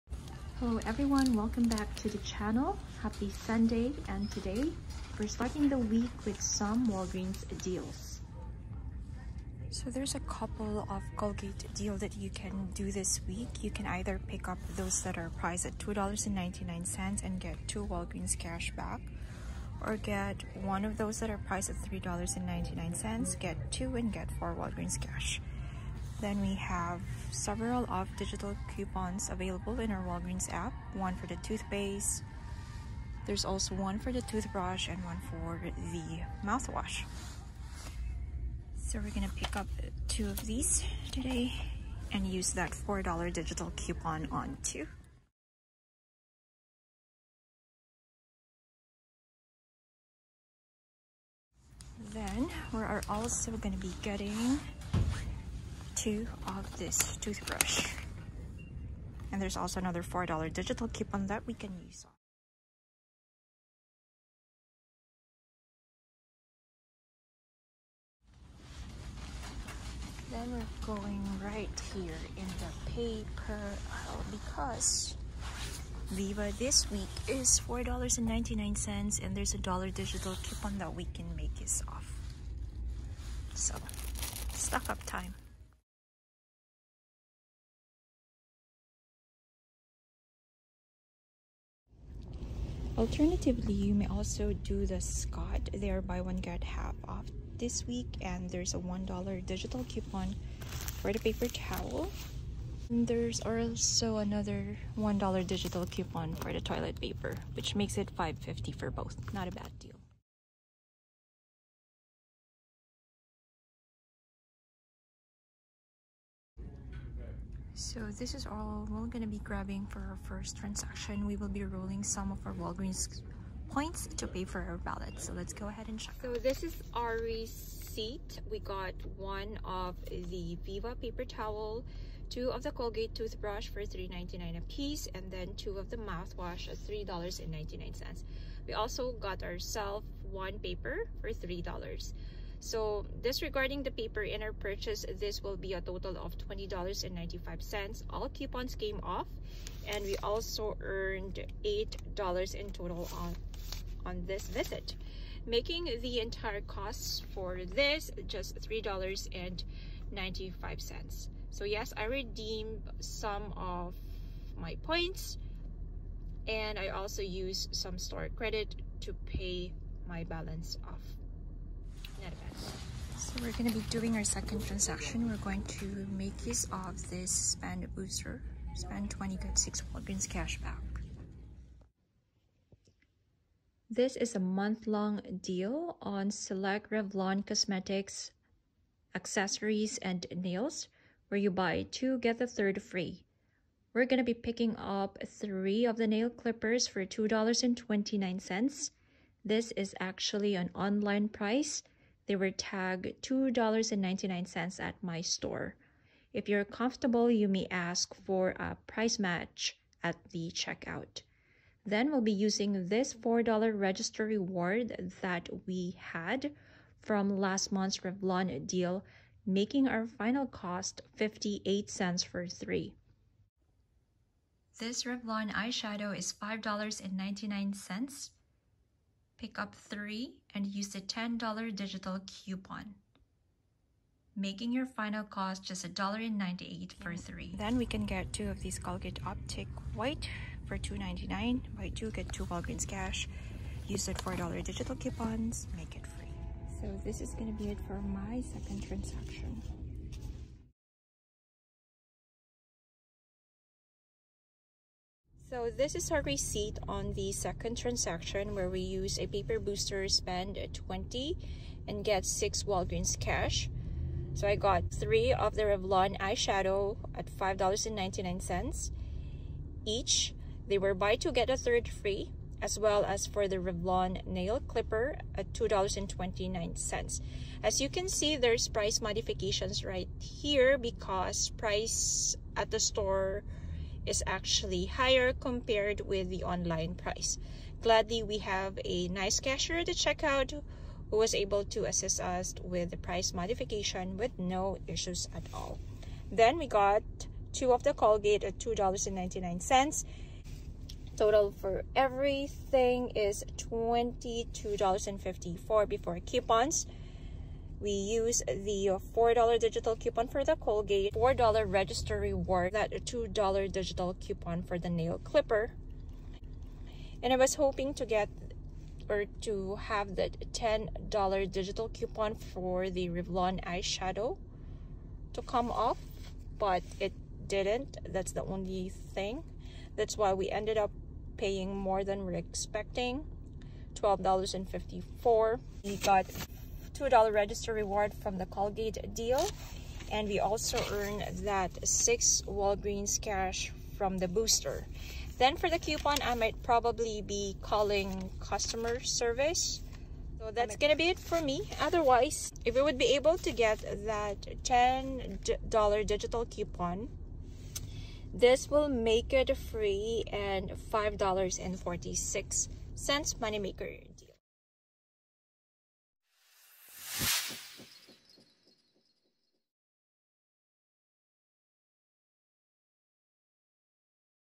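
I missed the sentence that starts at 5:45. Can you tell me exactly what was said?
Then for the coupon, I might probably be calling customer service.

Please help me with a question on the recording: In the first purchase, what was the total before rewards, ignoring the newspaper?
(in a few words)
$20.95.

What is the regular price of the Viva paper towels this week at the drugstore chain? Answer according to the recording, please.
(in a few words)
$4.99.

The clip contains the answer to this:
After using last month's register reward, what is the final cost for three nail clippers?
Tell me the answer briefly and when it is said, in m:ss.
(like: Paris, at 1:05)
58 cents, at 3:41.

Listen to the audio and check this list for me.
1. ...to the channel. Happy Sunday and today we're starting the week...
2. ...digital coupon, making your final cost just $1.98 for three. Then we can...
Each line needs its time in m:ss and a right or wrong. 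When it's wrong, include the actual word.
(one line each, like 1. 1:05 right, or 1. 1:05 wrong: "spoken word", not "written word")
1. 0:01 right
2. 3:51 right.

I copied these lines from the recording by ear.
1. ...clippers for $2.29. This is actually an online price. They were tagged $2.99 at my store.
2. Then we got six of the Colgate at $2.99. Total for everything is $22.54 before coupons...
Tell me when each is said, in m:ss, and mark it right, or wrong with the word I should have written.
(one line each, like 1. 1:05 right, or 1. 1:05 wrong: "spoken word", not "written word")
1. 3:16 right
2. 4:56 wrong: "two", not "six".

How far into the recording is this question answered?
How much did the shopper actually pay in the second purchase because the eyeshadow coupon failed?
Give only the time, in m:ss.
5:33.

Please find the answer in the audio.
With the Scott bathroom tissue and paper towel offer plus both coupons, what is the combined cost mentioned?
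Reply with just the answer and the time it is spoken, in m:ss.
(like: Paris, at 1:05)
$5.50, at 1:48.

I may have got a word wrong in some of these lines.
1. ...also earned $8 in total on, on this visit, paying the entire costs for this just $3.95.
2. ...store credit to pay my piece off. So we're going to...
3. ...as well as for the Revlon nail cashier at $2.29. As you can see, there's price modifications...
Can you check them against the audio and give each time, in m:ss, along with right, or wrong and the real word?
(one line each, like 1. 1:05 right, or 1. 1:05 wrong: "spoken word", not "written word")
1. 2:30 wrong: "making", not "paying"
2. 2:47 wrong: "balance", not "piece"
3. 4:32 wrong: "clipper", not "cashier".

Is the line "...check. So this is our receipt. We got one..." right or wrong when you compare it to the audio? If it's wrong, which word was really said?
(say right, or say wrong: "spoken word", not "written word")
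right.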